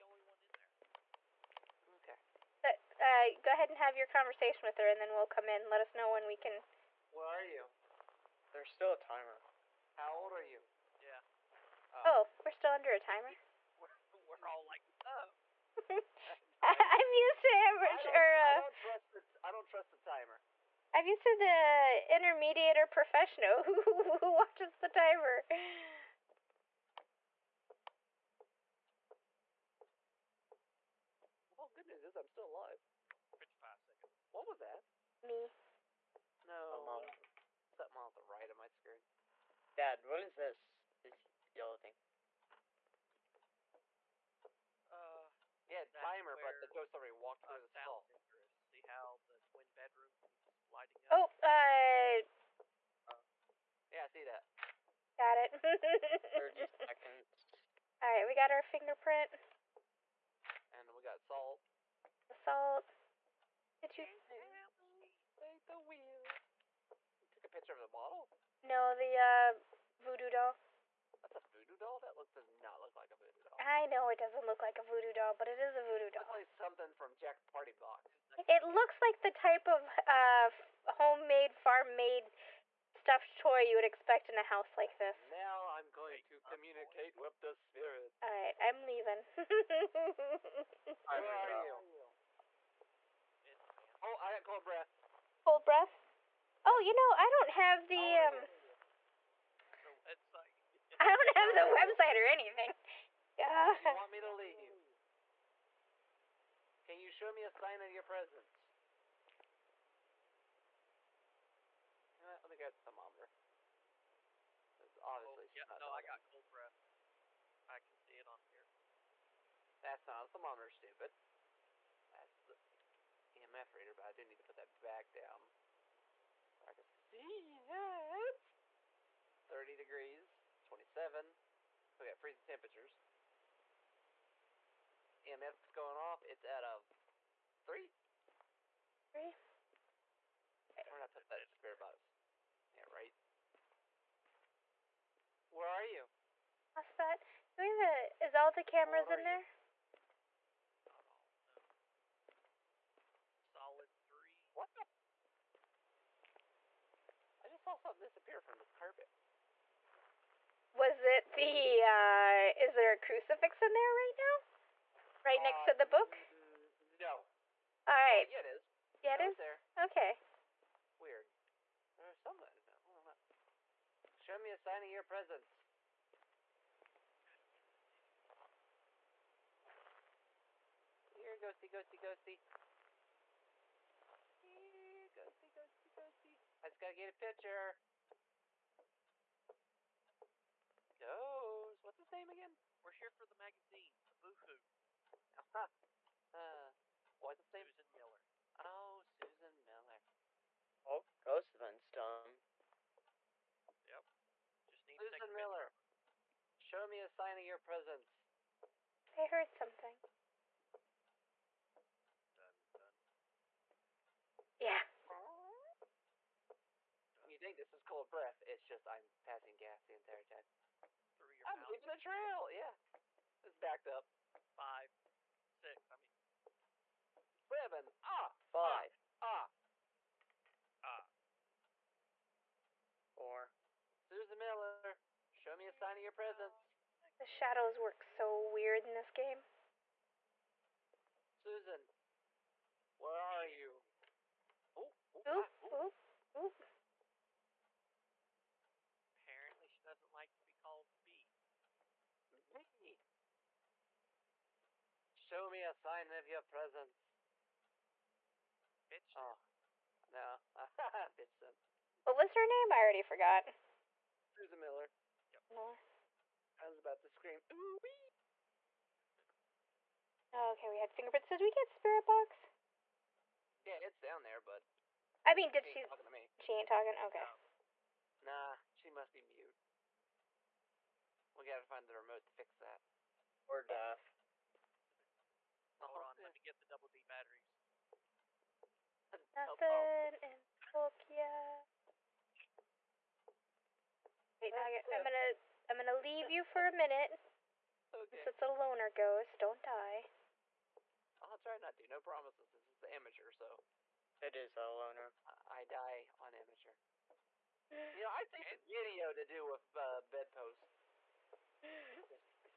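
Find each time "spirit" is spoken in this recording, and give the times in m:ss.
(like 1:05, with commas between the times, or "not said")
1:27, 2:21, 4:31.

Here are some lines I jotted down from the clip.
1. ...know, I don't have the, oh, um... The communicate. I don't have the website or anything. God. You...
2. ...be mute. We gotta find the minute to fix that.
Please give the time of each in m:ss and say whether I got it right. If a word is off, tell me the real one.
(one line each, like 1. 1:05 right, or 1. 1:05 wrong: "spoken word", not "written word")
1. 1:36 wrong: "website", not "communicate"
2. 4:39 wrong: "remote", not "minute".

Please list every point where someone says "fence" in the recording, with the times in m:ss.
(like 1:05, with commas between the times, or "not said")
not said.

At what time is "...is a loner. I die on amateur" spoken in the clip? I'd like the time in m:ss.
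5:04.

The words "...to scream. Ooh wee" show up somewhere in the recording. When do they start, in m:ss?
4:27.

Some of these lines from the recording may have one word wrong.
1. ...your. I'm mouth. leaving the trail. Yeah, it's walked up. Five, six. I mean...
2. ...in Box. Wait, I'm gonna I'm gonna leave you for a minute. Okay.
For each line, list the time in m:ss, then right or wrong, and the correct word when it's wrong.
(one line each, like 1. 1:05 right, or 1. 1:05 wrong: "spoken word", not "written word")
1. 3:41 wrong: "backed", not "walked"
2. 4:50 wrong: "Tokyo", not "Box".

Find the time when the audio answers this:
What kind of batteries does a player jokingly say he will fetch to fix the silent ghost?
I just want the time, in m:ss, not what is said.
4:46.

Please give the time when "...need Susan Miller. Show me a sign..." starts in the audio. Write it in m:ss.
3:24.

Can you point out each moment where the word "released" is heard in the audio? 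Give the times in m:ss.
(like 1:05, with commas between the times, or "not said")
not said.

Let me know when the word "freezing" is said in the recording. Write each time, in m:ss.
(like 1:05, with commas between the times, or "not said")
2:12.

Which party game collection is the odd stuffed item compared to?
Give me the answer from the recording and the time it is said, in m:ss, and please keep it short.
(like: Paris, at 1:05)
Jack Party Box, at 1:17.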